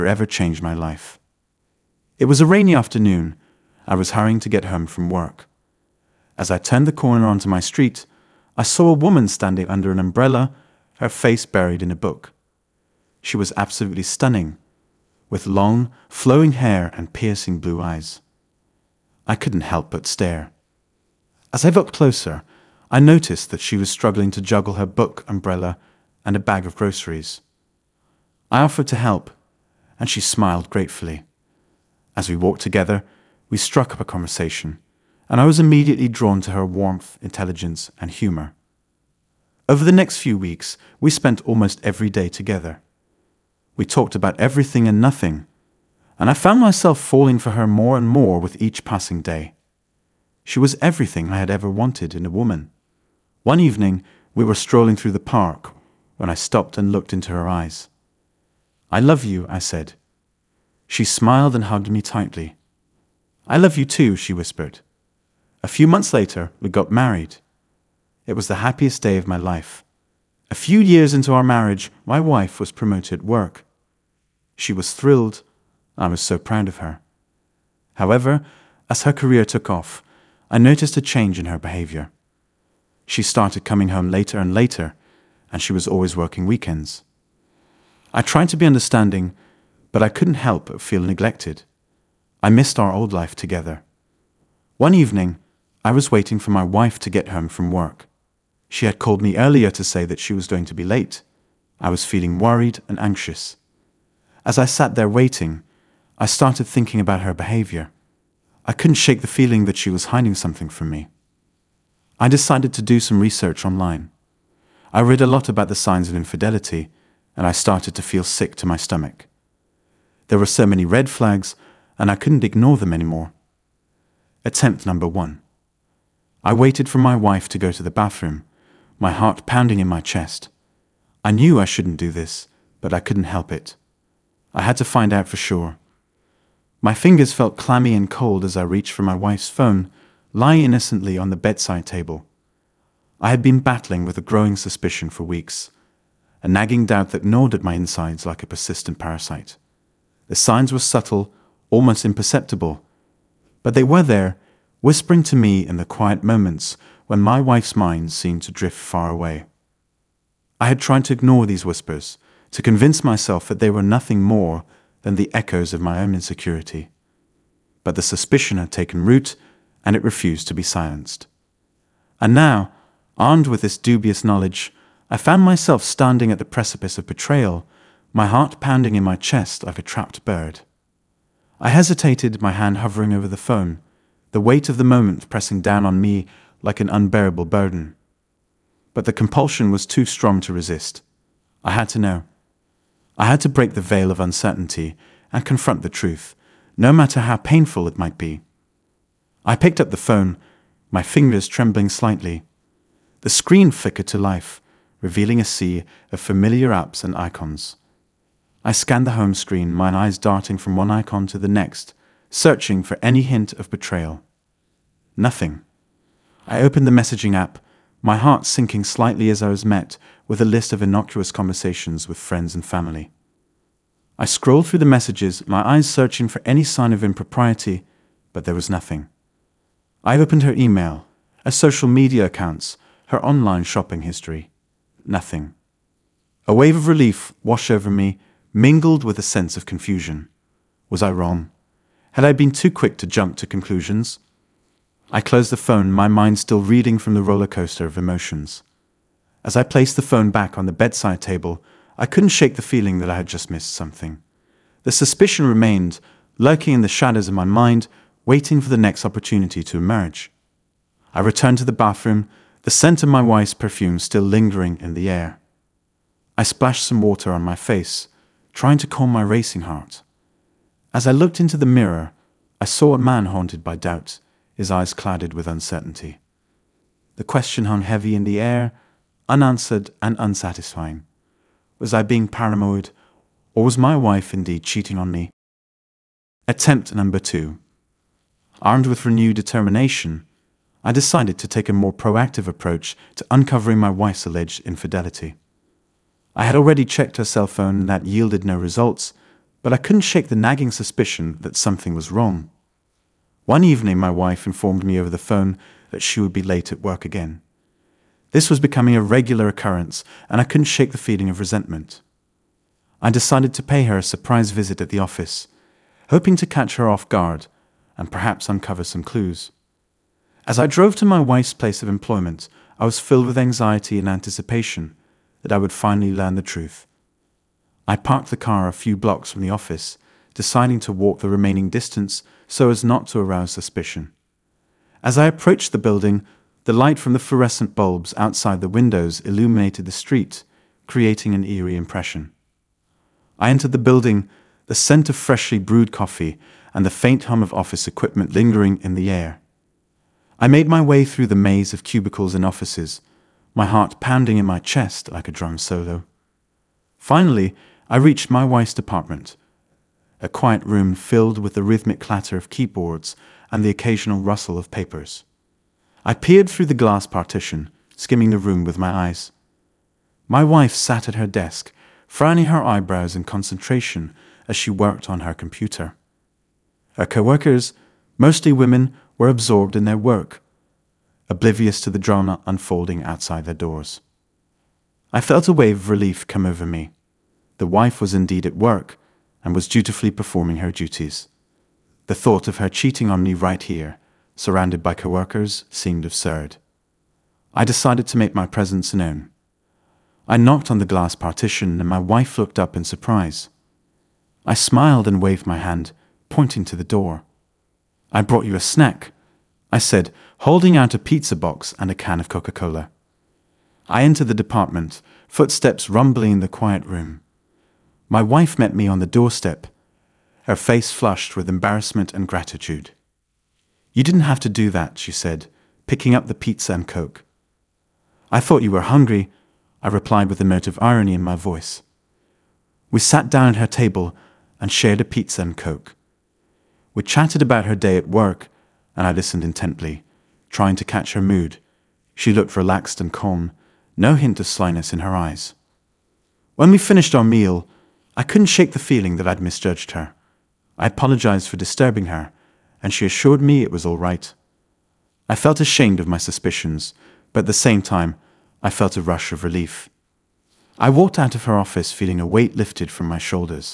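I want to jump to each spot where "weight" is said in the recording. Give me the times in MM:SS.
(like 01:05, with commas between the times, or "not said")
03:04, 07:42.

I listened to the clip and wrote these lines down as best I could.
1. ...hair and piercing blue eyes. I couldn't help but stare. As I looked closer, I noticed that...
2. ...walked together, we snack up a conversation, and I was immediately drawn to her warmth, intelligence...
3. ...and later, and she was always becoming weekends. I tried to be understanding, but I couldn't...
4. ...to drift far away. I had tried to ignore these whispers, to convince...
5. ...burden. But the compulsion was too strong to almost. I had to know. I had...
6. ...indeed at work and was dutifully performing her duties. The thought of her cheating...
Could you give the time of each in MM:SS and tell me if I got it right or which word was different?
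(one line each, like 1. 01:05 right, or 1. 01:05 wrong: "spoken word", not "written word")
1. 00:16 right
2. 00:32 wrong: "struck", not "snack"
3. 01:24 wrong: "working", not "becoming"
4. 02:38 right
5. 03:07 wrong: "resist", not "almost"
6. 06:28 right.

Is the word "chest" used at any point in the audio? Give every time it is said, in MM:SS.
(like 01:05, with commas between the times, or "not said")
02:10, 02:59, 05:54.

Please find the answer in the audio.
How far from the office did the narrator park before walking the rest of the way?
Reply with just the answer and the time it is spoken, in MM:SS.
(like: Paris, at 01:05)
a few blocks, at 05:28.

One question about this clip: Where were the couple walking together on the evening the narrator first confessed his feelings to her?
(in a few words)
the park.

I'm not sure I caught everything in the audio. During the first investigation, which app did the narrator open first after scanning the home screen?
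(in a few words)
messaging app.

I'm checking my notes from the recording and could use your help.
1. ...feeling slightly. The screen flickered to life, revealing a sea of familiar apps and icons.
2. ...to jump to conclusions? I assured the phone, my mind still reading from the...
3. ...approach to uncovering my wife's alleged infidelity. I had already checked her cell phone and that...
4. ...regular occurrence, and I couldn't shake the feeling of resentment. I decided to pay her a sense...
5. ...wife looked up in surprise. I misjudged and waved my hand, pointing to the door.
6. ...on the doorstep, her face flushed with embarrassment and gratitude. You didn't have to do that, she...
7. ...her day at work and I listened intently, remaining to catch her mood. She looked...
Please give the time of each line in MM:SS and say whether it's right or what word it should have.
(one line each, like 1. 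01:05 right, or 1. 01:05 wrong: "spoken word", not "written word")
1. 03:21 wrong: "trembling", not "feeling"
2. 04:02 wrong: "closed", not "assured"
3. 04:52 right
4. 05:09 wrong: "surprise", not "sense"
5. 06:41 wrong: "smiled", not "misjudged"
6. 06:58 right
7. 07:17 wrong: "trying", not "remaining".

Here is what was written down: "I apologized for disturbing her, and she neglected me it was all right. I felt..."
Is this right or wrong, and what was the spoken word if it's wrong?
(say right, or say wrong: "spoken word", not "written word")
wrong: "assured", not "neglected".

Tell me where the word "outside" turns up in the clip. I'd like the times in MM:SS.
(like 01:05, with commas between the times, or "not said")
05:38, 06:23.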